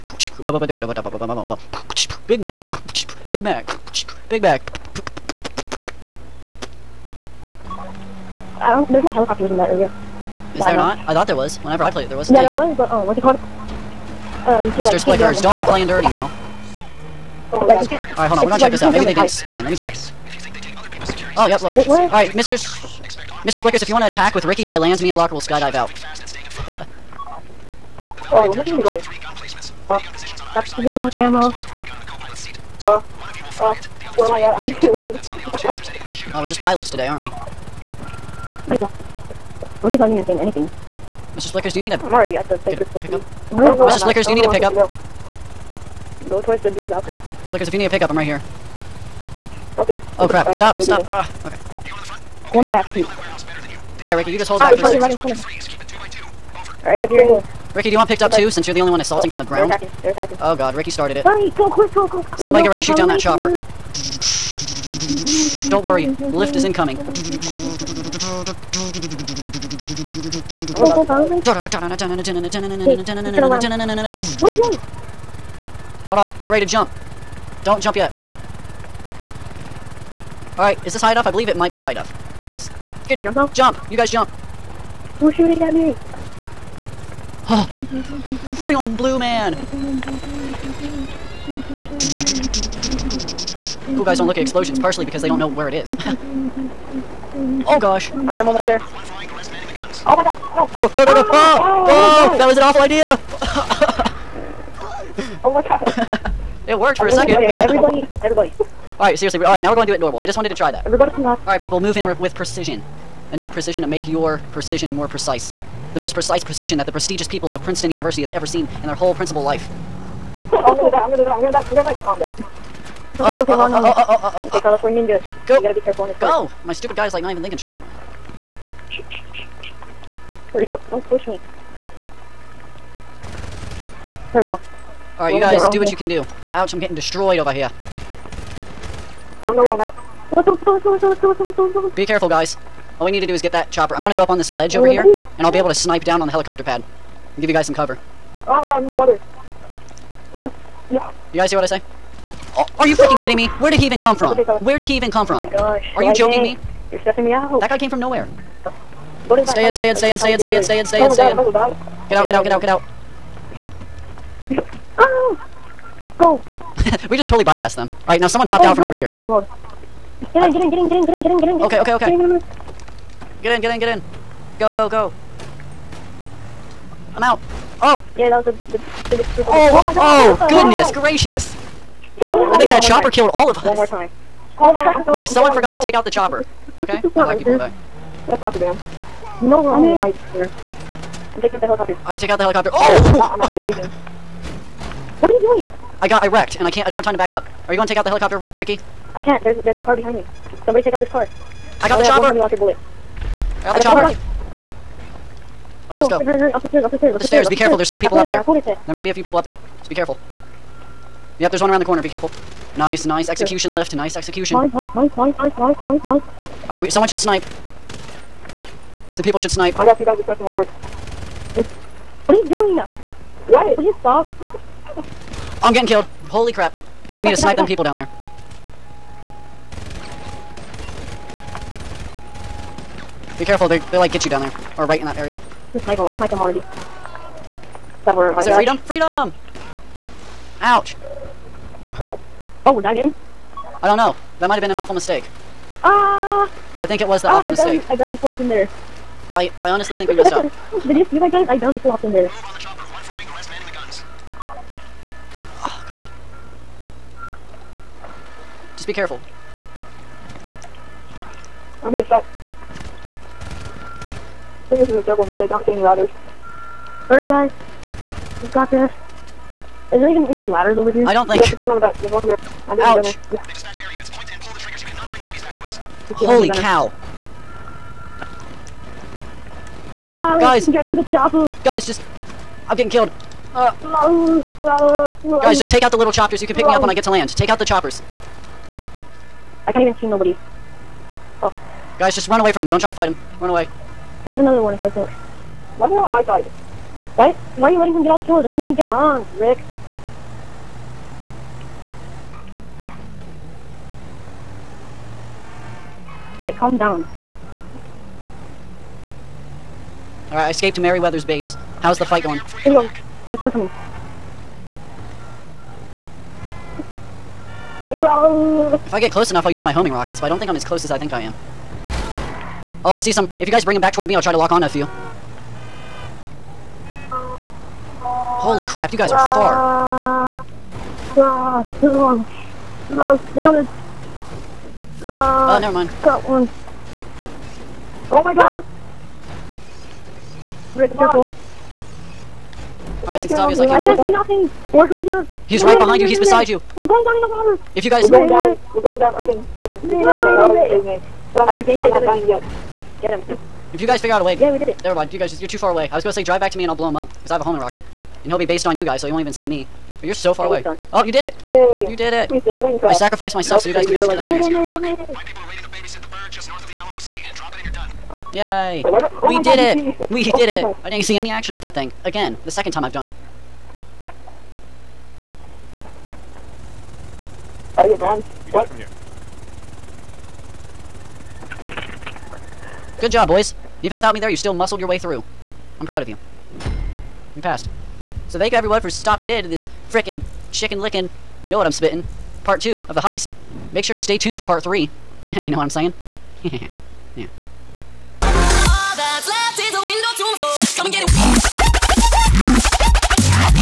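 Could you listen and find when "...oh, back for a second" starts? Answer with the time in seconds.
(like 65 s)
54 s.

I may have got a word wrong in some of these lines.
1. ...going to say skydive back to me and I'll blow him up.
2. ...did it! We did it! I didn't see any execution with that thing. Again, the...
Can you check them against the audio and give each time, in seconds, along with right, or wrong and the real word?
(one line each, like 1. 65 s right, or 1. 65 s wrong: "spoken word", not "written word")
1. 356 s wrong: "drive", not "skydive"
2. 369 s wrong: "action", not "execution".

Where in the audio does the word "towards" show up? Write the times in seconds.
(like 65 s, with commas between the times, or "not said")
46 s, 323 s.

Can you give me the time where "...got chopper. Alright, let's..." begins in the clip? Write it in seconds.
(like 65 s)
203 s.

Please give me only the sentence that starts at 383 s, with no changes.
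Even without me there, you still muscled your way through.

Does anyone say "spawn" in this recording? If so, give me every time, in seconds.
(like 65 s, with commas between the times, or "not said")
19 s.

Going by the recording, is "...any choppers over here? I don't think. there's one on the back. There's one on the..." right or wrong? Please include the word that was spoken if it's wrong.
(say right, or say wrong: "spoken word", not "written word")
wrong: "ladders", not "choppers".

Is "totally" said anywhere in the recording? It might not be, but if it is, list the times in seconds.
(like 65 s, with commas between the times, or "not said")
167 s.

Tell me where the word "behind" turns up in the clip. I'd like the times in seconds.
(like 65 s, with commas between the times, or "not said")
199 s, 345 s.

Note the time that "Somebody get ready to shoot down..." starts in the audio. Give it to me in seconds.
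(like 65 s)
62 s.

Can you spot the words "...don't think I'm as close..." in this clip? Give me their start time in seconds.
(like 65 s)
320 s.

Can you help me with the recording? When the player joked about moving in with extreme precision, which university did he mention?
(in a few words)
Princeton University.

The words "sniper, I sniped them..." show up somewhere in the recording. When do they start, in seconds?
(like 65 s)
235 s.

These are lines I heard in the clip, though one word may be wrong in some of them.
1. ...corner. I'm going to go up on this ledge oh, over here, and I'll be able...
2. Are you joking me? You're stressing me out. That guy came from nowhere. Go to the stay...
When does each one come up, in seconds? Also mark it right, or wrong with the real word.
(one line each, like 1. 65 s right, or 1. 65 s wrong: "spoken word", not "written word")
1. 143 s wrong: "chopper", not "corner"
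2. 155 s right.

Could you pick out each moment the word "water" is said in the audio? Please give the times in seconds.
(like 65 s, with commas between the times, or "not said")
148 s, 347 s.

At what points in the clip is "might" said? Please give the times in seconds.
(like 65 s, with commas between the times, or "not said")
81 s, 208 s, 244 s.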